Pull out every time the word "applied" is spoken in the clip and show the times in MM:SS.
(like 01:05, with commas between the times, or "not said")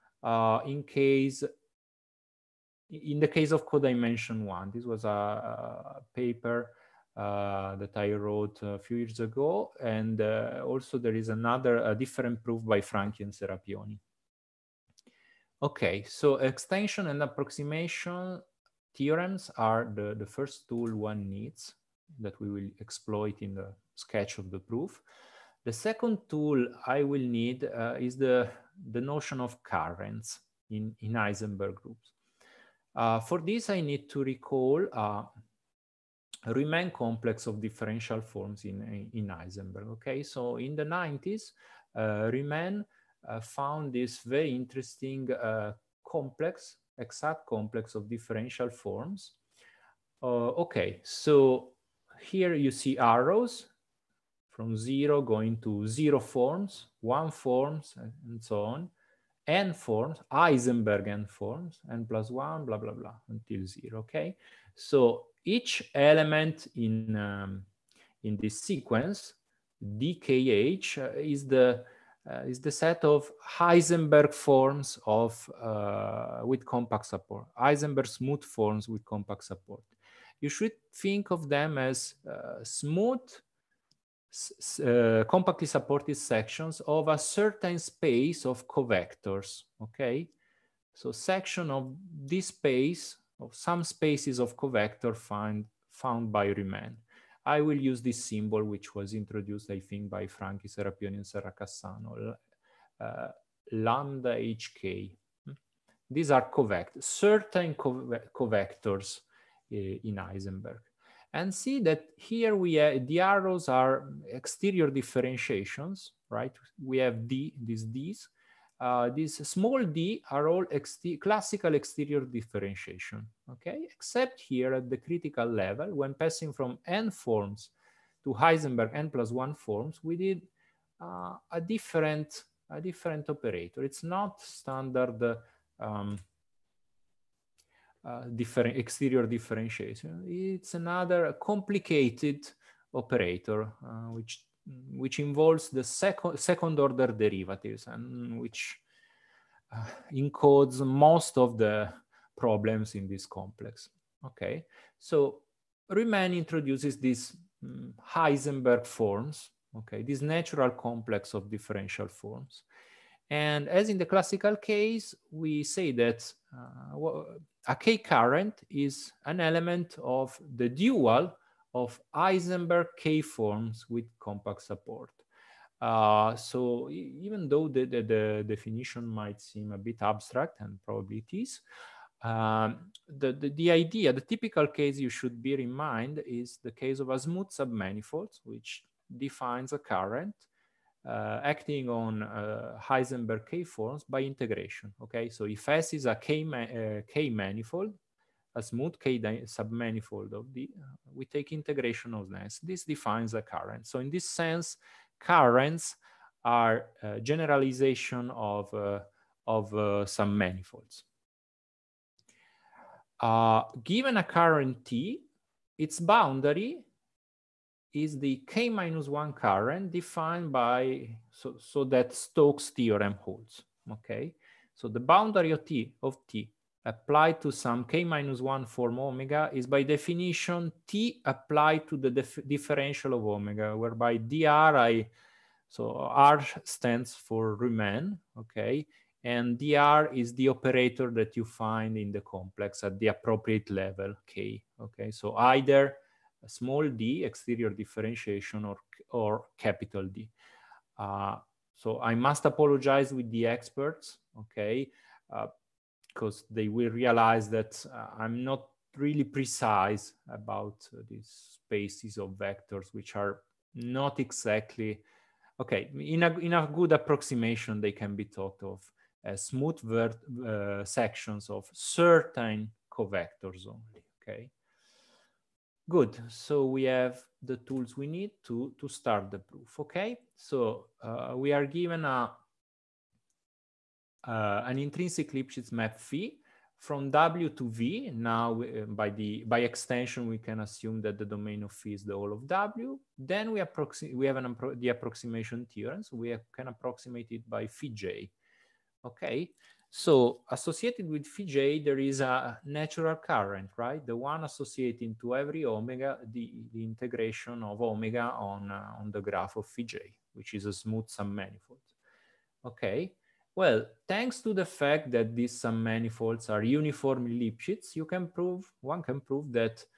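03:46, 03:51.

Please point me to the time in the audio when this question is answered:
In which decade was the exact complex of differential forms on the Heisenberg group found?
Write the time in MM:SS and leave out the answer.
00:40.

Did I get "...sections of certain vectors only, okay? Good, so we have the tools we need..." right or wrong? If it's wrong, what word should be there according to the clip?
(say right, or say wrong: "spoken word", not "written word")
wrong: "covectors", not "vectors".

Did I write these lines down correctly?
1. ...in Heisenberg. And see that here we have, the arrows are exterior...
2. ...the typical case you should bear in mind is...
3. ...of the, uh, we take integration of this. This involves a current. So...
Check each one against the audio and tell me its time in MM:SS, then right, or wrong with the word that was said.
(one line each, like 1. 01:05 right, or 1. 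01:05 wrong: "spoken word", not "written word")
1. 01:49 right
2. 03:04 right
3. 03:20 wrong: "defines", not "involves".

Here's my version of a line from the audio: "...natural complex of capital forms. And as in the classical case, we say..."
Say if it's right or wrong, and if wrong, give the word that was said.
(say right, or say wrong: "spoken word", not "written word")
wrong: "differential", not "capital".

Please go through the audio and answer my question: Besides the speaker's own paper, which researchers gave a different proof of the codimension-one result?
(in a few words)
Franchi and Serapioni.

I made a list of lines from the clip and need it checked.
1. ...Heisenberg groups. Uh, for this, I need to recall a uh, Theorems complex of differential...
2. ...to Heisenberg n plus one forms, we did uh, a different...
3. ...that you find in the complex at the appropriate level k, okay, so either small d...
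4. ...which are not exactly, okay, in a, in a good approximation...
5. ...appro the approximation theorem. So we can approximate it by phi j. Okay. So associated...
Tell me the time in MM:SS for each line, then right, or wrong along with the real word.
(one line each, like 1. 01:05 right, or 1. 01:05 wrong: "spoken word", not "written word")
1. 00:31 wrong: "Rumin", not "Theorems"
2. 02:08 right
3. 04:01 right
4. 04:22 right
5. 04:54 right.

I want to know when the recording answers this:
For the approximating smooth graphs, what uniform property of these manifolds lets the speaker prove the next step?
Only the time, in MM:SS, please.
05:16.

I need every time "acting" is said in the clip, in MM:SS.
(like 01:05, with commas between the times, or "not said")
03:11.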